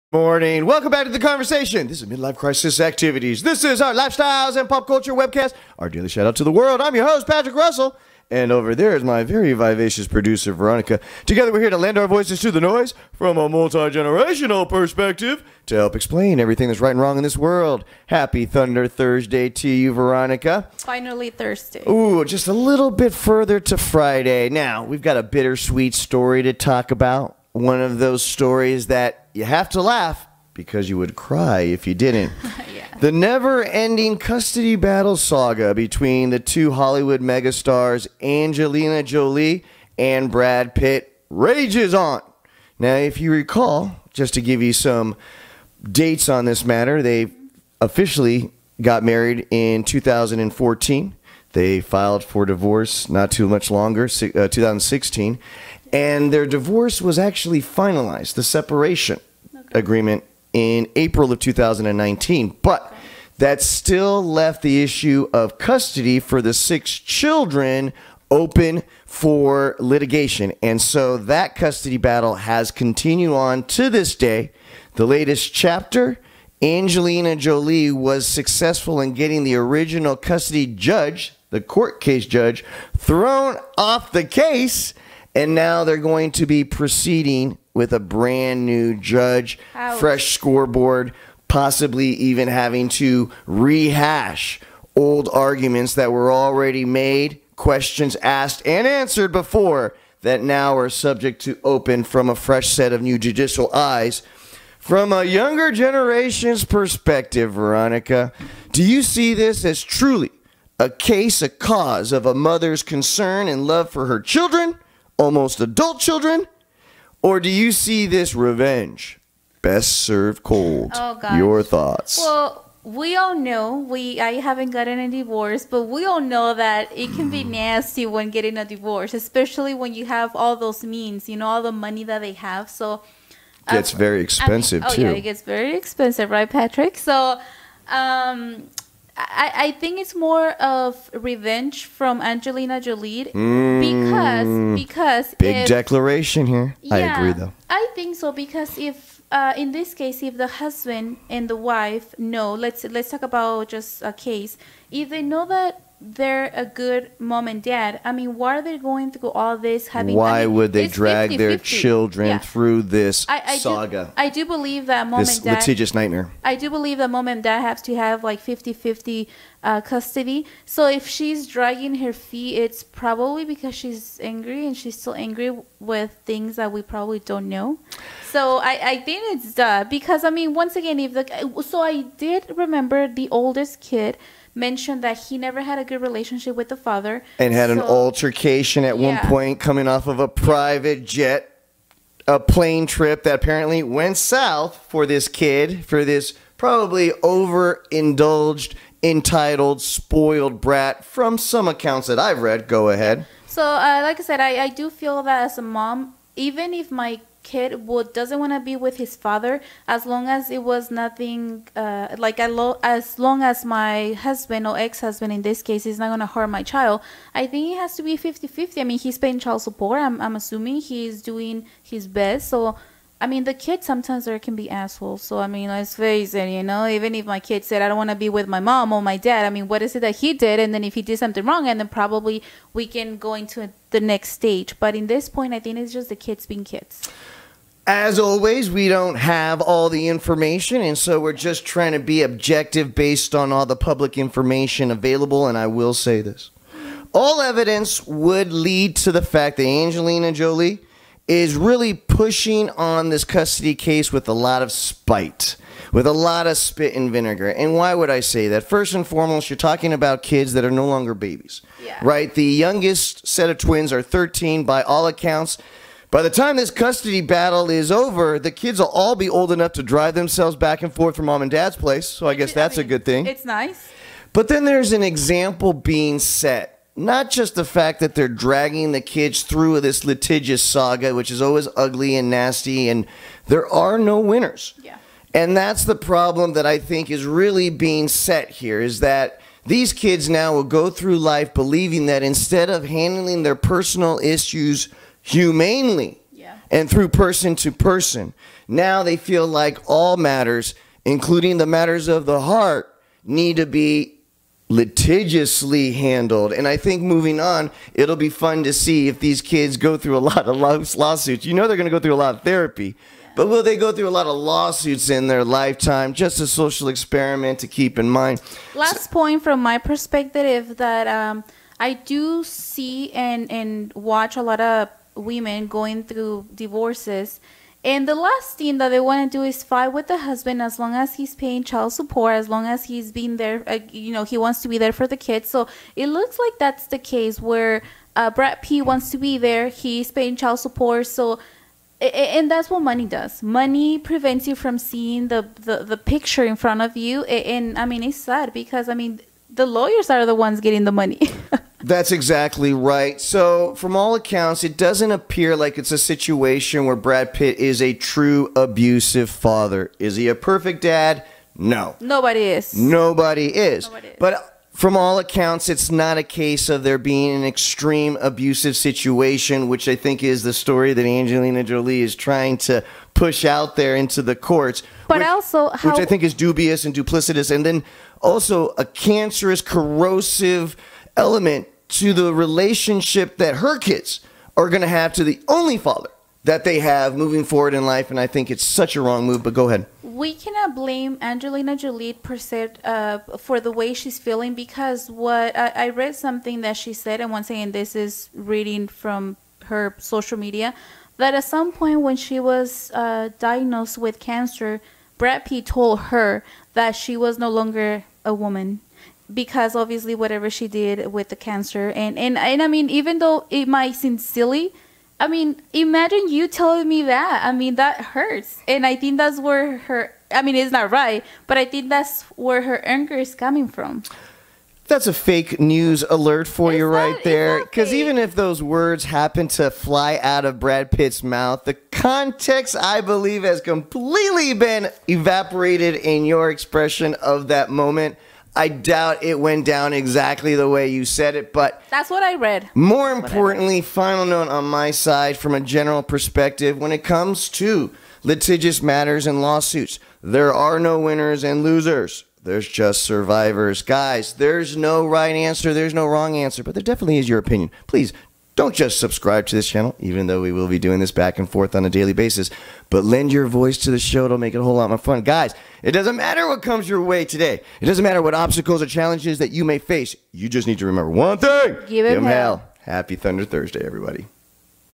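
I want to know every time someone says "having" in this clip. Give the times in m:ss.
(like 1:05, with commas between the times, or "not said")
1:32, 2:39.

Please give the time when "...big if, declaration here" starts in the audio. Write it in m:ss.
2:25.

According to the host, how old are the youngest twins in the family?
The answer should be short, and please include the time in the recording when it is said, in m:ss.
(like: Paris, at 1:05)
13, at 4:24.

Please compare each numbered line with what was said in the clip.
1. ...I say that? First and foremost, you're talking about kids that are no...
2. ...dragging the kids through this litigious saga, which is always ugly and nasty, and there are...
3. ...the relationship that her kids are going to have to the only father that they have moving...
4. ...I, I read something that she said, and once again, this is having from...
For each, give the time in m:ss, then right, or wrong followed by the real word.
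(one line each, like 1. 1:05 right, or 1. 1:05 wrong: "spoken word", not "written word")
1. 4:18 right
2. 4:38 right
3. 6:22 right
4. 6:35 wrong: "reading", not "having".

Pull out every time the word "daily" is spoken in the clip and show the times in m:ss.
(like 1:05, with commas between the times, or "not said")
0:05, 7:41.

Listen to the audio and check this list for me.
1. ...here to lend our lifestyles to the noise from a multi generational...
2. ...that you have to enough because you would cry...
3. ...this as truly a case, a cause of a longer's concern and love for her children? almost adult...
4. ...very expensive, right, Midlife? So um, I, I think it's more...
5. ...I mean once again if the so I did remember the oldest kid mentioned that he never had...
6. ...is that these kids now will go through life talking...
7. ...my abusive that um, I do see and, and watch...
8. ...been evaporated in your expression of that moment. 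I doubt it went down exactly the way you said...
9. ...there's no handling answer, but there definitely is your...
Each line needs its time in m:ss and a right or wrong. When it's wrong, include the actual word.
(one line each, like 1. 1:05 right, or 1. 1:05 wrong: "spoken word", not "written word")
1. 0:11 wrong: "voices", not "lifestyles"
2. 0:28 wrong: "laugh", not "enough"
3. 1:49 wrong: "mother", not "longer"
4. 2:15 wrong: "Patrick", not "Midlife"
5. 3:00 right
6. 4:48 wrong: "believing", not "talking"
7. 5:19 wrong: "perspective", not "abusive"
8. 7:14 right
9. 7:35 wrong: "wrong", not "handling".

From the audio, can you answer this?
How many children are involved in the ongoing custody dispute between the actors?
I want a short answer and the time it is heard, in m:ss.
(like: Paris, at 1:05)
6, at 1:06.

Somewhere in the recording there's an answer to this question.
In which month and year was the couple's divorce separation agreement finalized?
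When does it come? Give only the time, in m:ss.
1:00.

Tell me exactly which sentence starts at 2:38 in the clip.
I mean, why are they going through all this?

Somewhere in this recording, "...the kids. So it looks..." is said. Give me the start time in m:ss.
5:35.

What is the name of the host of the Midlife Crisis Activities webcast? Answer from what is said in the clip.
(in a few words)
Patrick Russell.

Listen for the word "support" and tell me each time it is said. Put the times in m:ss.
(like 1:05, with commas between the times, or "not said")
3:39, 5:31, 5:40.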